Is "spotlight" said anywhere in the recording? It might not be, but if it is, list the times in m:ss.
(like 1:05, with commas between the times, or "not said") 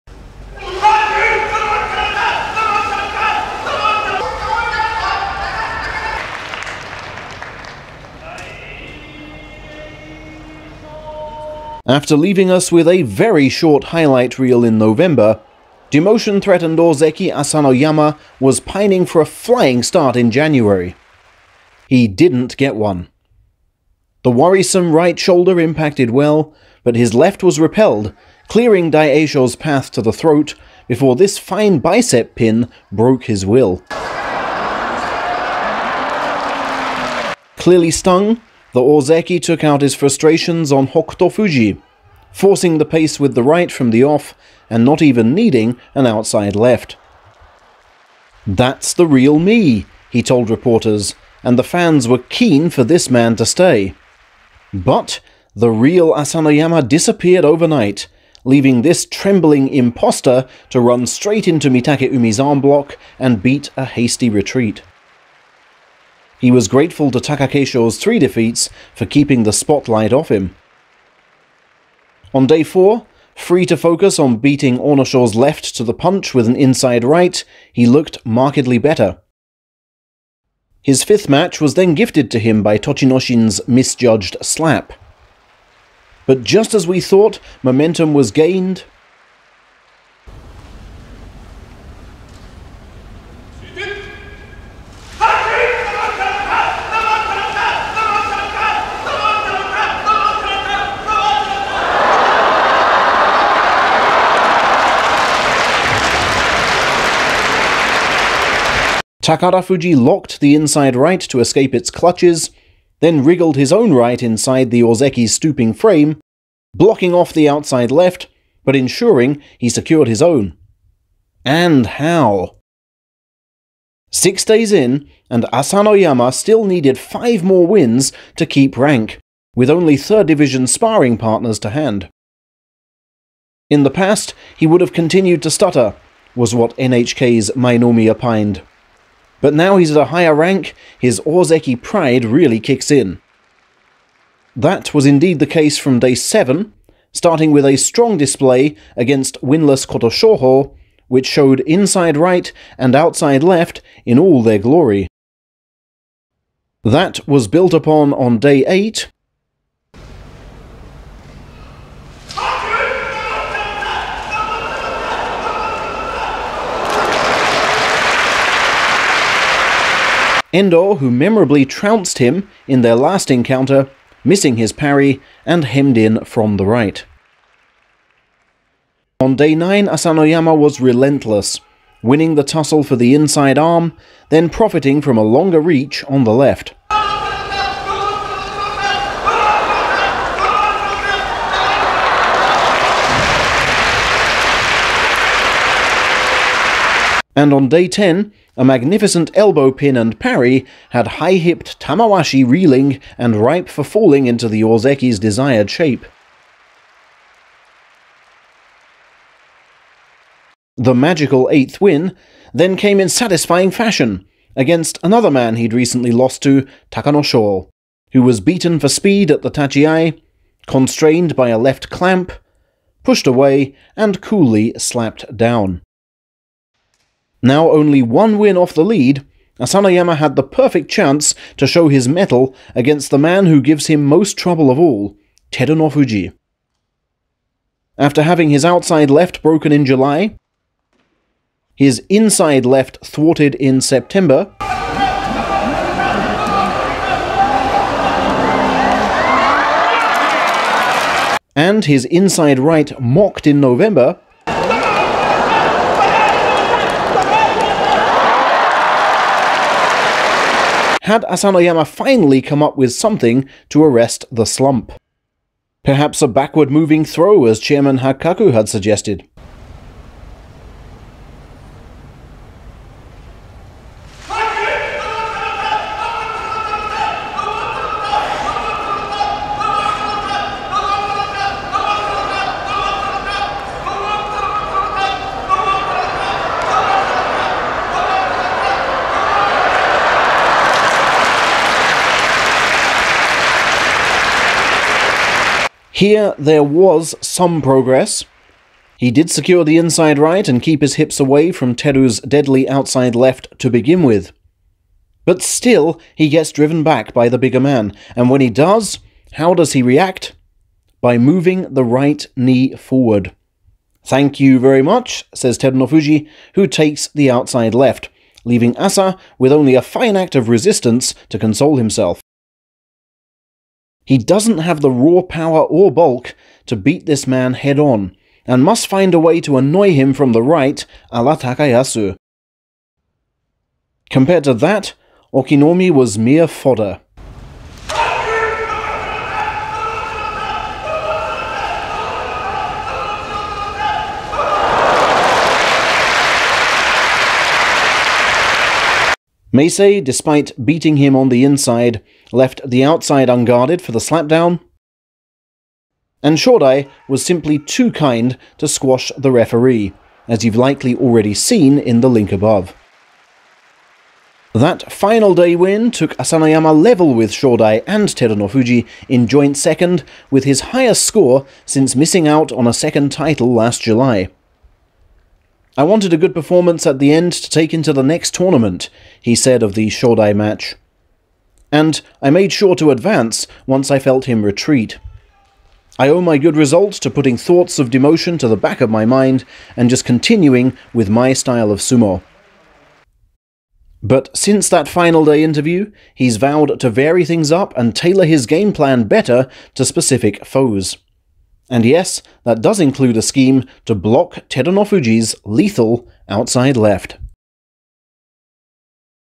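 1:09.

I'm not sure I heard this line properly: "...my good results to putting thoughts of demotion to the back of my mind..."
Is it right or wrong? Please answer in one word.
right.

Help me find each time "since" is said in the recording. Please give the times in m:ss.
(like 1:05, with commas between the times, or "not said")
6:11, 6:34.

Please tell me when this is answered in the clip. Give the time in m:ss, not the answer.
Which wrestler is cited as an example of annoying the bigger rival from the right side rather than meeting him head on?
5:31.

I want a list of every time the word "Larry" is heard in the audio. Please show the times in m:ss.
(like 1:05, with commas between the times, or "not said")
not said.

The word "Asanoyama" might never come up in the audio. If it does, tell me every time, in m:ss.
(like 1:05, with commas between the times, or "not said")
0:17, 0:56, 2:05, 2:59, 3:49, 4:21, 6:06.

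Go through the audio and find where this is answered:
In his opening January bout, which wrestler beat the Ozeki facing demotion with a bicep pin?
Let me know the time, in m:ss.
0:28.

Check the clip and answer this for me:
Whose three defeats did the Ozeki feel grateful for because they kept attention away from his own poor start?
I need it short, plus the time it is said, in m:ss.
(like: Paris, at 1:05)
Takakeisho, at 1:07.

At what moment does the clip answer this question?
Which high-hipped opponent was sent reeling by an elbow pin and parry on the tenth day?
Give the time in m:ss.
3:21.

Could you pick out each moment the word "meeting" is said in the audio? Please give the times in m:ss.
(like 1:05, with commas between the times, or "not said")
not said.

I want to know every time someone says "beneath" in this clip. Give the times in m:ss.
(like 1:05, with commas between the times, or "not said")
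not said.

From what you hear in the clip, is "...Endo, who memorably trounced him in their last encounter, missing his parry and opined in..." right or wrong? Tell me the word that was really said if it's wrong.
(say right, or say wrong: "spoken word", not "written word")
wrong: "hemmed", not "opined".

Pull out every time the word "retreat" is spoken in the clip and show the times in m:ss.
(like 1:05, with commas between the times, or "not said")
1:04, 6:24.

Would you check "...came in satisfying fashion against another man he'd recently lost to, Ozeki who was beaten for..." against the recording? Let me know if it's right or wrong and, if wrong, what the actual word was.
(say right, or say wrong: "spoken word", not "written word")
wrong: "Takano", not "Ozeki".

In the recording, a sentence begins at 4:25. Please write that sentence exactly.
Perhaps a backward moving throw, as Chairman Hakkaku had suggested.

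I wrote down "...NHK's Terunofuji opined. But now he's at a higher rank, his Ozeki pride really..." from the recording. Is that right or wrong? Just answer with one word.
wrong.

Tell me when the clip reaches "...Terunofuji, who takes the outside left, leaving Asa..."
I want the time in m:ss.
5:15.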